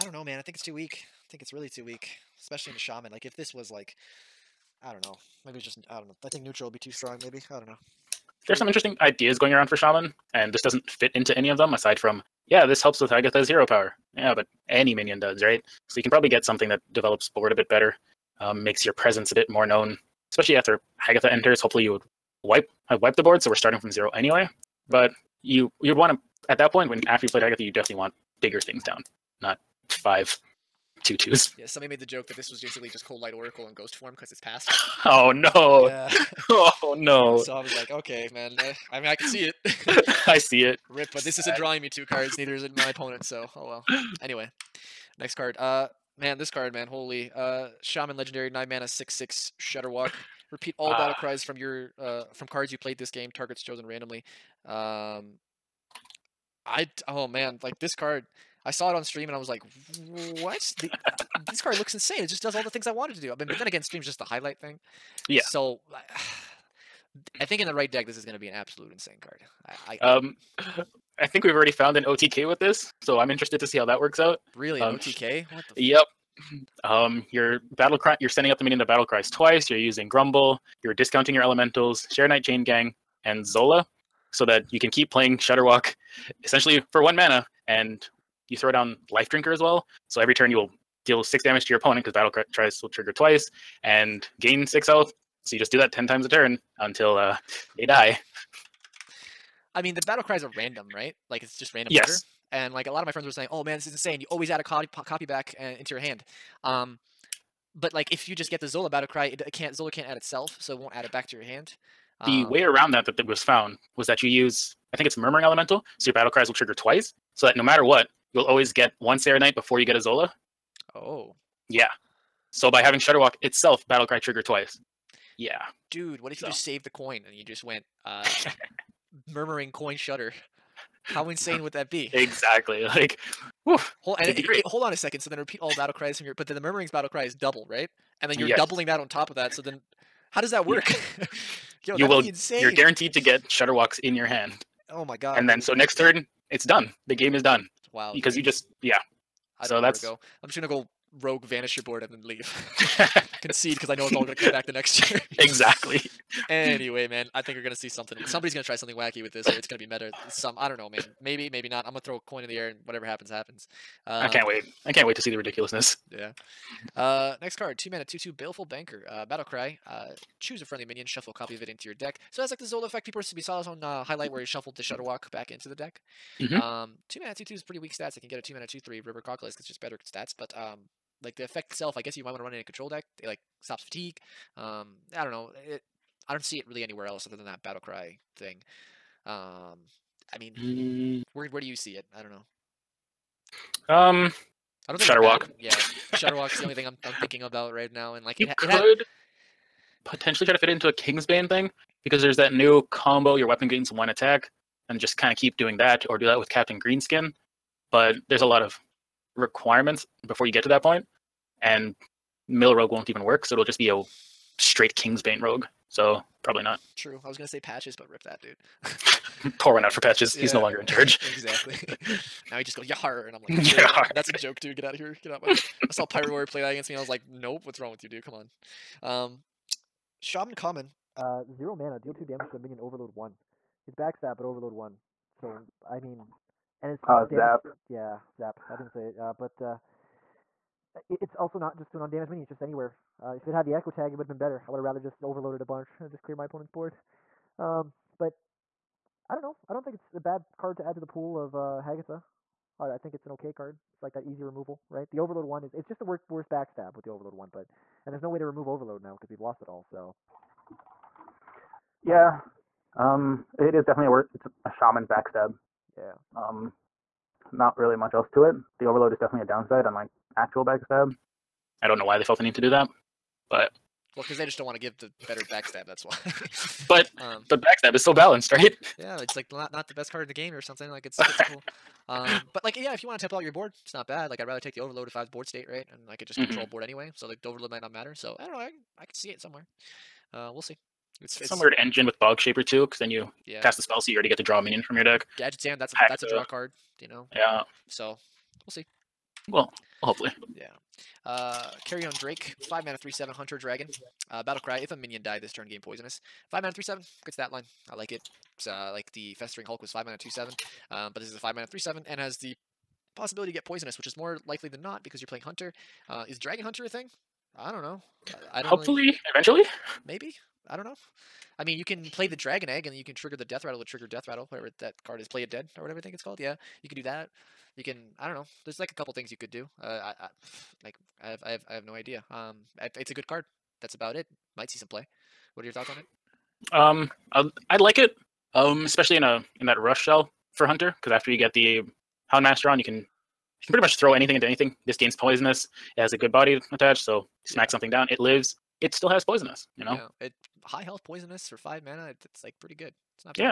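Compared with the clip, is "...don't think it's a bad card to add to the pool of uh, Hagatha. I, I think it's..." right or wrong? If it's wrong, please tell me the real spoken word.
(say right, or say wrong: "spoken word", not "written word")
right.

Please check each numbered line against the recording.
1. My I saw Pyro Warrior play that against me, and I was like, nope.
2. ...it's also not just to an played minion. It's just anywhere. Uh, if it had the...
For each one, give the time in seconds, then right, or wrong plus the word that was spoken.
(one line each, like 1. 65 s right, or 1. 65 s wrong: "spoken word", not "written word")
1. 225 s right
2. 241 s wrong: "undamaged", not "played".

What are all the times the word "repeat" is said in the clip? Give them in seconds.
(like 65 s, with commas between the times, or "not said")
50 s, 135 s.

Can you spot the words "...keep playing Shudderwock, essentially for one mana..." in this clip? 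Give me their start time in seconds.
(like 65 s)
84 s.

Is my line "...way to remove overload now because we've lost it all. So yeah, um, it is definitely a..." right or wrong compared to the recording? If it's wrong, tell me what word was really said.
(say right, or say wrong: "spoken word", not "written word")
right.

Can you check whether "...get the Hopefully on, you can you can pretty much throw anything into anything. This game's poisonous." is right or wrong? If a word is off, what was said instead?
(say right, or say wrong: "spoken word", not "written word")
wrong: "Master", not "Hopefully".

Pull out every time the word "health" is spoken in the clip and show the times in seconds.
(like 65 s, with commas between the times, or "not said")
94 s, 350 s.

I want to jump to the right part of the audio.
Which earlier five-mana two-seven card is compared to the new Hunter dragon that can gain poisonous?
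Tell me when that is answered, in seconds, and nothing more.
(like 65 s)
309 s.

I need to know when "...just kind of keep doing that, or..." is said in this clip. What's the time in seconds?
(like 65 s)
204 s.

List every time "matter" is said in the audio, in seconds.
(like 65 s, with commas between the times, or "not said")
117 s, 287 s.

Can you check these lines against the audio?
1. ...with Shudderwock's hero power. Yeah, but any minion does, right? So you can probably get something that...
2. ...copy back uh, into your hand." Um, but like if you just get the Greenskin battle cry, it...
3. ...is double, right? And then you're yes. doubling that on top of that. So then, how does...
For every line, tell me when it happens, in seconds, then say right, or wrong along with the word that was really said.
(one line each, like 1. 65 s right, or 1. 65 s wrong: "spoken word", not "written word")
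1. 13 s wrong: "Agatha", not "Shudderwock"
2. 105 s wrong: "Zola", not "Greenskin"
3. 137 s right.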